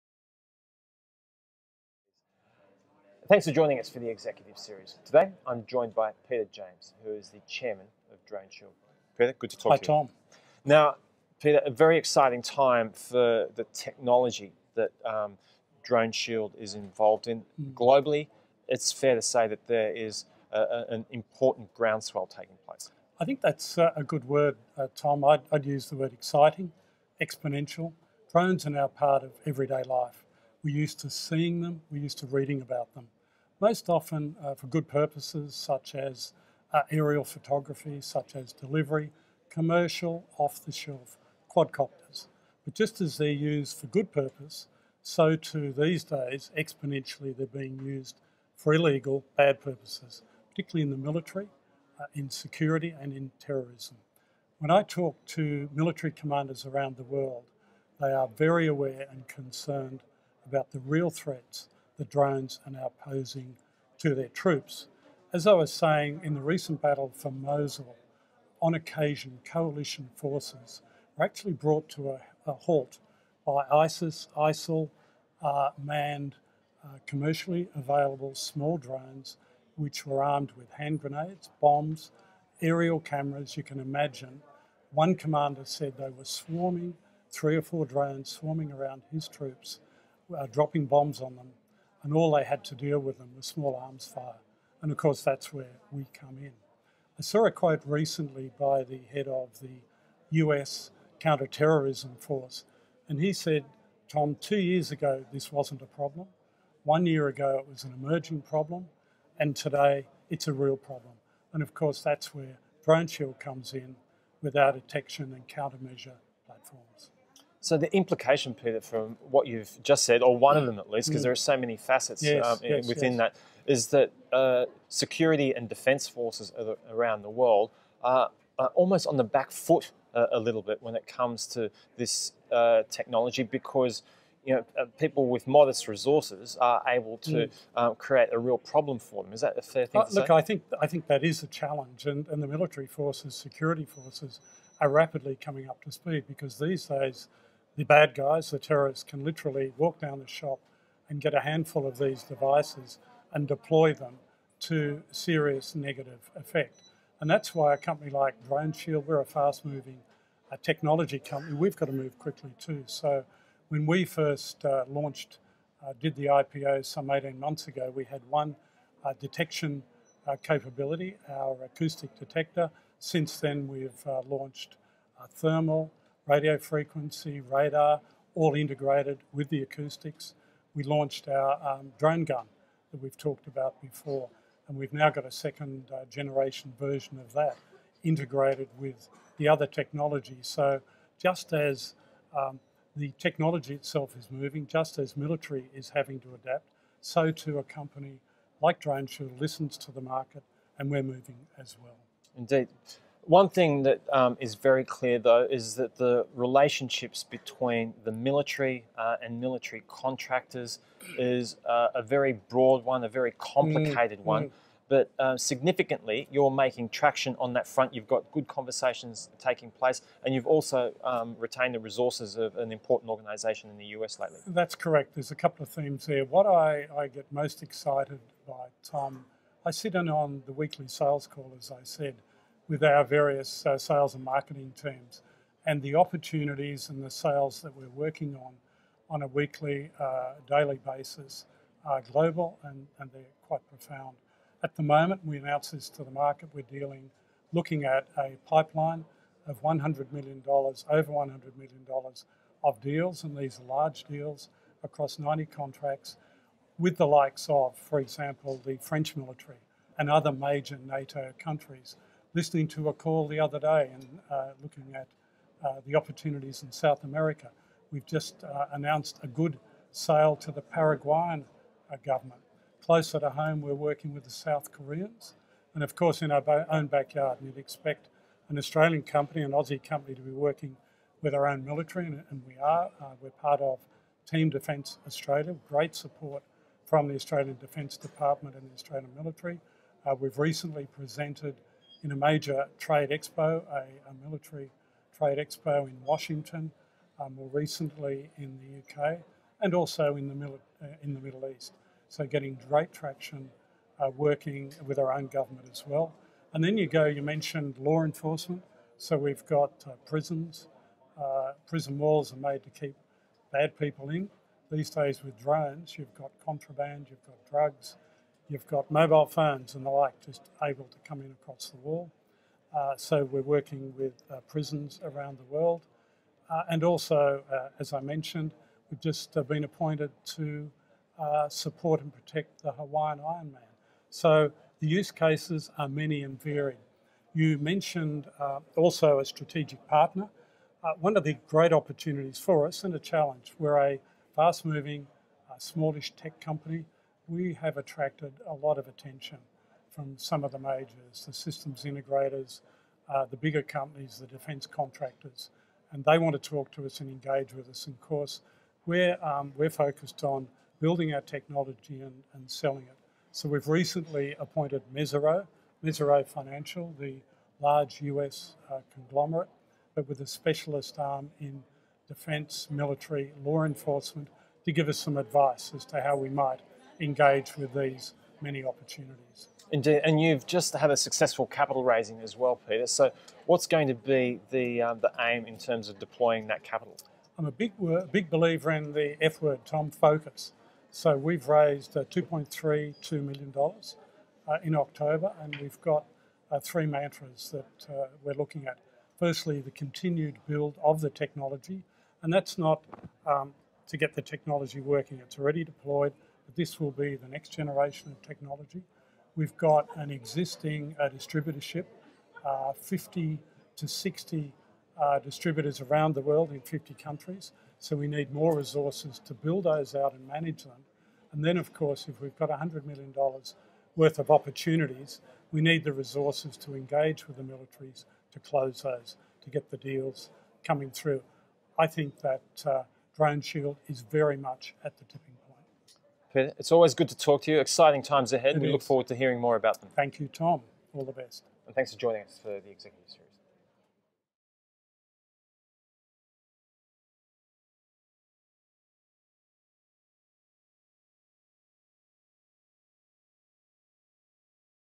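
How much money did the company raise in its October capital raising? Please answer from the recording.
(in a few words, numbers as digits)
$2.32 million.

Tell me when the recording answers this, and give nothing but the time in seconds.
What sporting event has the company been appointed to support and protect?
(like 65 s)
332 s.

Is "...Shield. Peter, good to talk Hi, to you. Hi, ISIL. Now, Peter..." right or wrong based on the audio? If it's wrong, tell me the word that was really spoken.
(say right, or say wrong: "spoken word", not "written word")
wrong: "Tom", not "ISIL".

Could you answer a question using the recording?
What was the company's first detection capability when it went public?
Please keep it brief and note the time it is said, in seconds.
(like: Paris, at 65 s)
acoustic detector, at 171 s.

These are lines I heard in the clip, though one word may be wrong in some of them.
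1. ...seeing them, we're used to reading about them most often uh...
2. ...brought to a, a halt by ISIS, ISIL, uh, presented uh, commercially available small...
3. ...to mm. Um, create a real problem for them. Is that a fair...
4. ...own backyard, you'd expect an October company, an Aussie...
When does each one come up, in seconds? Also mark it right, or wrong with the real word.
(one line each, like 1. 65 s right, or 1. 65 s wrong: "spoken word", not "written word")
1. 31 s right
2. 71 s wrong: "manned", not "presented"
3. 137 s right
4. 276 s wrong: "Australian", not "October".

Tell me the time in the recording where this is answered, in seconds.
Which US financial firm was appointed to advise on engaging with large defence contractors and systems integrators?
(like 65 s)
365 s.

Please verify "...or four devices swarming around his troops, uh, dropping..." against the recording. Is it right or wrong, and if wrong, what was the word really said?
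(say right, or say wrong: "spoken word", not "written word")
wrong: "drones", not "devices".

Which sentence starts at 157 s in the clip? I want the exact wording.
And that's why a company like DroneShield, we're a fast moving uh, technology company, we've got to move quickly too.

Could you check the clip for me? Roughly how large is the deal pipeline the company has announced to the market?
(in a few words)
over $100 million.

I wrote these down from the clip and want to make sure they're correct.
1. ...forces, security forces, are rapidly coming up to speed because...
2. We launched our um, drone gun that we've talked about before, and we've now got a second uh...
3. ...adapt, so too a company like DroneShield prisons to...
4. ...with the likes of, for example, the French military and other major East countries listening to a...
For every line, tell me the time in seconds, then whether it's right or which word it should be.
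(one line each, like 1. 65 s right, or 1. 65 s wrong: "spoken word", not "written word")
1. 142 s right
2. 180 s right
3. 196 s wrong: "listens", not "prisons"
4. 256 s wrong: "NATO", not "East".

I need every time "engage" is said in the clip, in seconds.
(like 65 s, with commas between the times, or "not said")
357 s, 377 s, 426 s.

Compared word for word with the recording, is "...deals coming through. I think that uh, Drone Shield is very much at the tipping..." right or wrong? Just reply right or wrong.
right.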